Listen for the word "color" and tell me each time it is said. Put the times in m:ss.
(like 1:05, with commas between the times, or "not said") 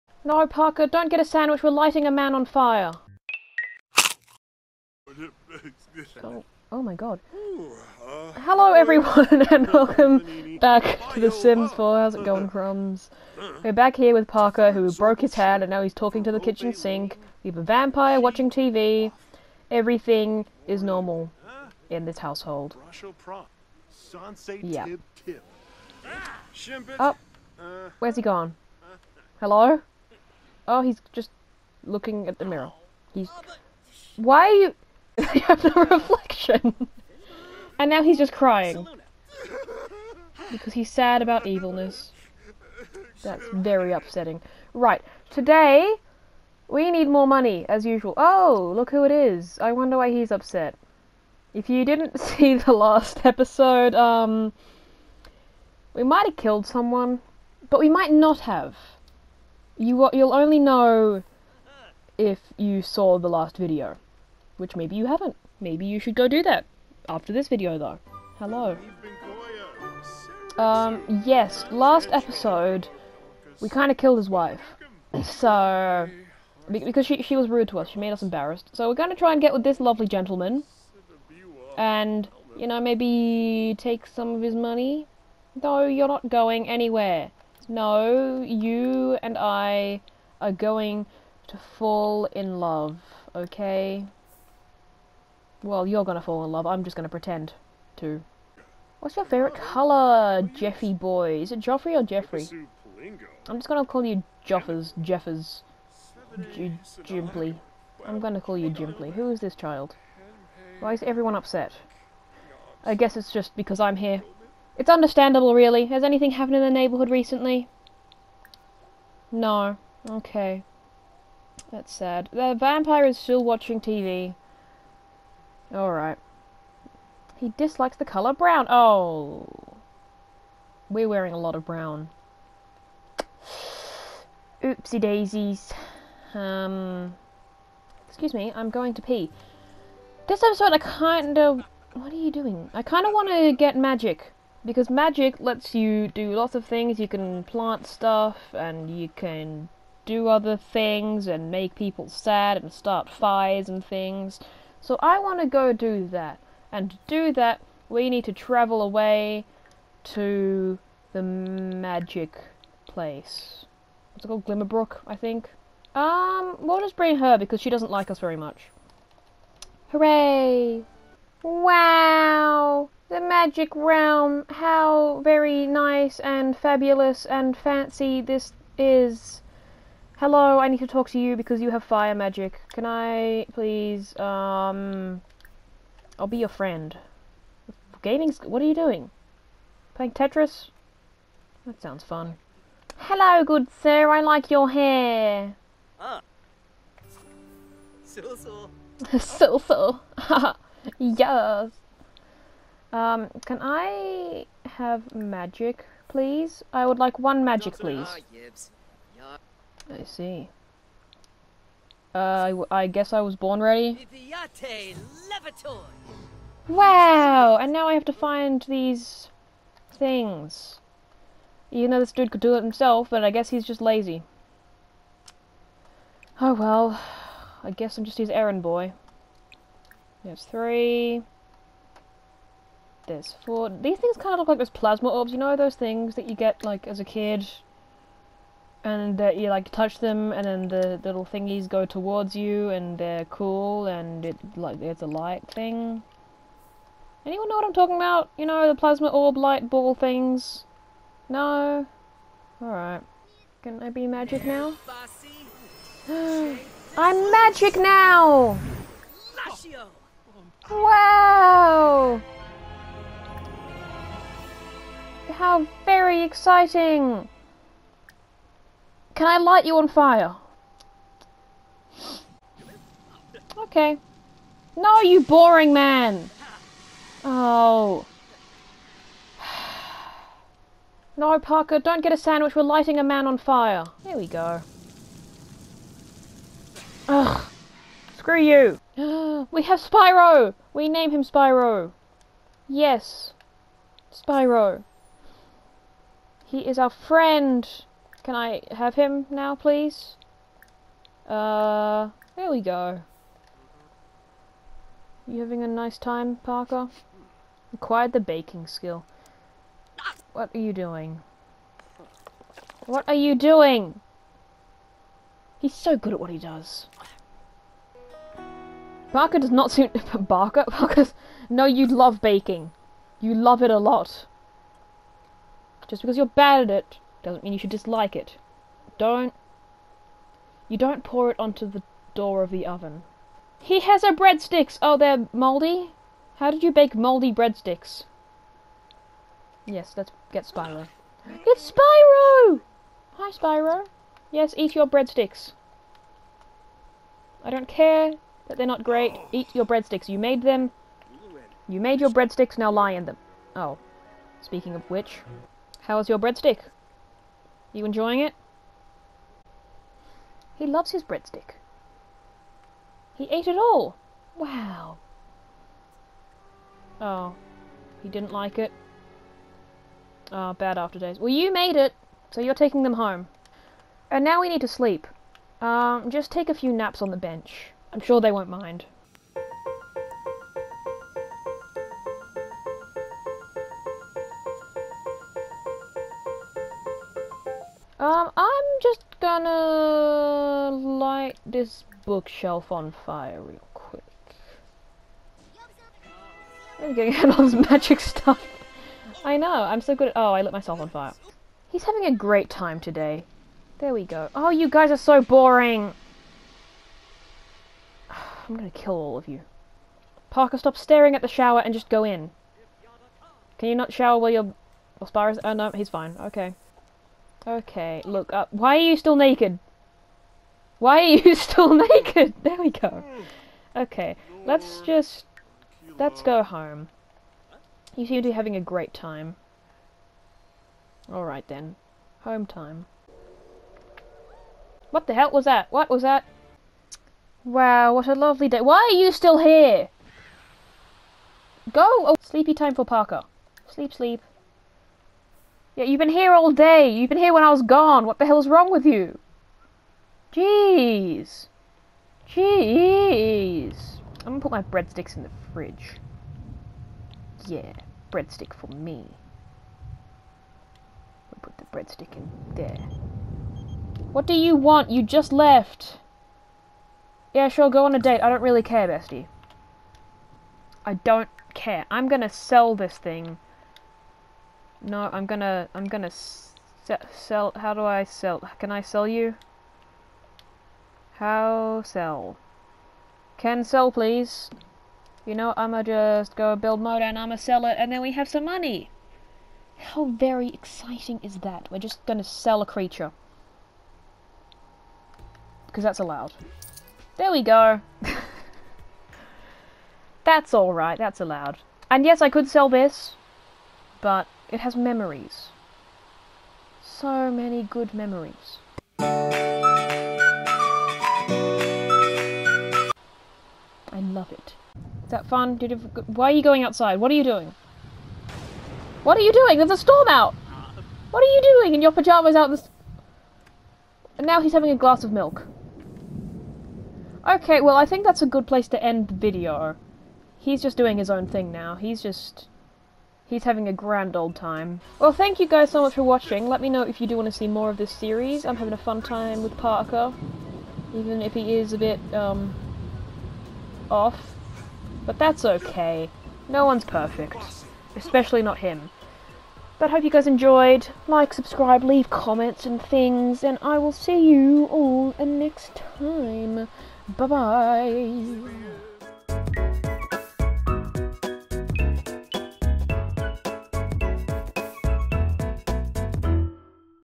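1:39, 2:08.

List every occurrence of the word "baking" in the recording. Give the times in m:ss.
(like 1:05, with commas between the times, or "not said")
5:08, 5:22.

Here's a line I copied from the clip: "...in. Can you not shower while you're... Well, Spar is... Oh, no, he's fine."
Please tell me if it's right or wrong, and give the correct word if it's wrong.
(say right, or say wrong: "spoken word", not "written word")
right.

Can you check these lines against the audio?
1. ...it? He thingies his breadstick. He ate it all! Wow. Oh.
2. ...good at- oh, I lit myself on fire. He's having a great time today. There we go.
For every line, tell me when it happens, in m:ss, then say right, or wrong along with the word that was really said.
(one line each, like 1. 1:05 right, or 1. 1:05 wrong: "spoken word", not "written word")
1. 5:58 wrong: "loves", not "thingies"
2. 6:39 right.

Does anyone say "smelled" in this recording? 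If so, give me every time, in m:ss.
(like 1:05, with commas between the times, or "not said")
not said.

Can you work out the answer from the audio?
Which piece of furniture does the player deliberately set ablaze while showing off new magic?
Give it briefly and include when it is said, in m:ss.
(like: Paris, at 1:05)
Bookshelf, at 6:31.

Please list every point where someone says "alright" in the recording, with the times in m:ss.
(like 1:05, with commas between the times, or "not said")
2:05, 7:11, 8:20.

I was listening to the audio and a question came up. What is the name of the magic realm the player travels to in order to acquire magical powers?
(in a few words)
Glimmerbrook.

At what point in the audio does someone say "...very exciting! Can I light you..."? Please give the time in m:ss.
4:25.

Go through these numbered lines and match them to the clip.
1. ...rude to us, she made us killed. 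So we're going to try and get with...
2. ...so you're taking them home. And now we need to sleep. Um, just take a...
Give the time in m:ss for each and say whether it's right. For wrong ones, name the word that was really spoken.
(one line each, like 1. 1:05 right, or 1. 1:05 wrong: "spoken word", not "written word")
1. 1:17 wrong: "embarrassed", not "killed"
2. 6:12 right.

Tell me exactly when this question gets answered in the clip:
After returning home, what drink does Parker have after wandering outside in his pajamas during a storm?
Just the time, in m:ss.
8:44.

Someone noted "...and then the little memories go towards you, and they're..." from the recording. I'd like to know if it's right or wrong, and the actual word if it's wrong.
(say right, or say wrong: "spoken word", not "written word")
wrong: "thingies", not "memories".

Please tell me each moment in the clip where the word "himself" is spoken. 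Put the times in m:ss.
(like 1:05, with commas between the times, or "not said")
3:42.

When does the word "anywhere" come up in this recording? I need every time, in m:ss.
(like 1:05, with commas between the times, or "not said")
1:26.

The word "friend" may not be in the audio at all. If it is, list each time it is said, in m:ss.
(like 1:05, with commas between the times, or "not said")
3:06, 4:56.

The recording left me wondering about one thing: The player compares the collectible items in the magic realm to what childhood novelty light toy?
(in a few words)
Plasma orbs.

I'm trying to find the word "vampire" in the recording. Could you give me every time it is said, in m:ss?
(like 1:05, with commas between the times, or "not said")
0:17, 2:02.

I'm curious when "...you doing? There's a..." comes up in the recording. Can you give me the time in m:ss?
8:39.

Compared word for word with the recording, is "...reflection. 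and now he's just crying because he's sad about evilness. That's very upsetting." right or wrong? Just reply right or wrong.
right.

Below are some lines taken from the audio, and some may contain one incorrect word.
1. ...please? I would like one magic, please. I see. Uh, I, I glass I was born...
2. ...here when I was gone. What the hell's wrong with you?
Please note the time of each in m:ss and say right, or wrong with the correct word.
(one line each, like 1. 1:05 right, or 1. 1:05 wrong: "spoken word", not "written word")
1. 3:26 wrong: "guess", not "glass"
2. 7:27 right.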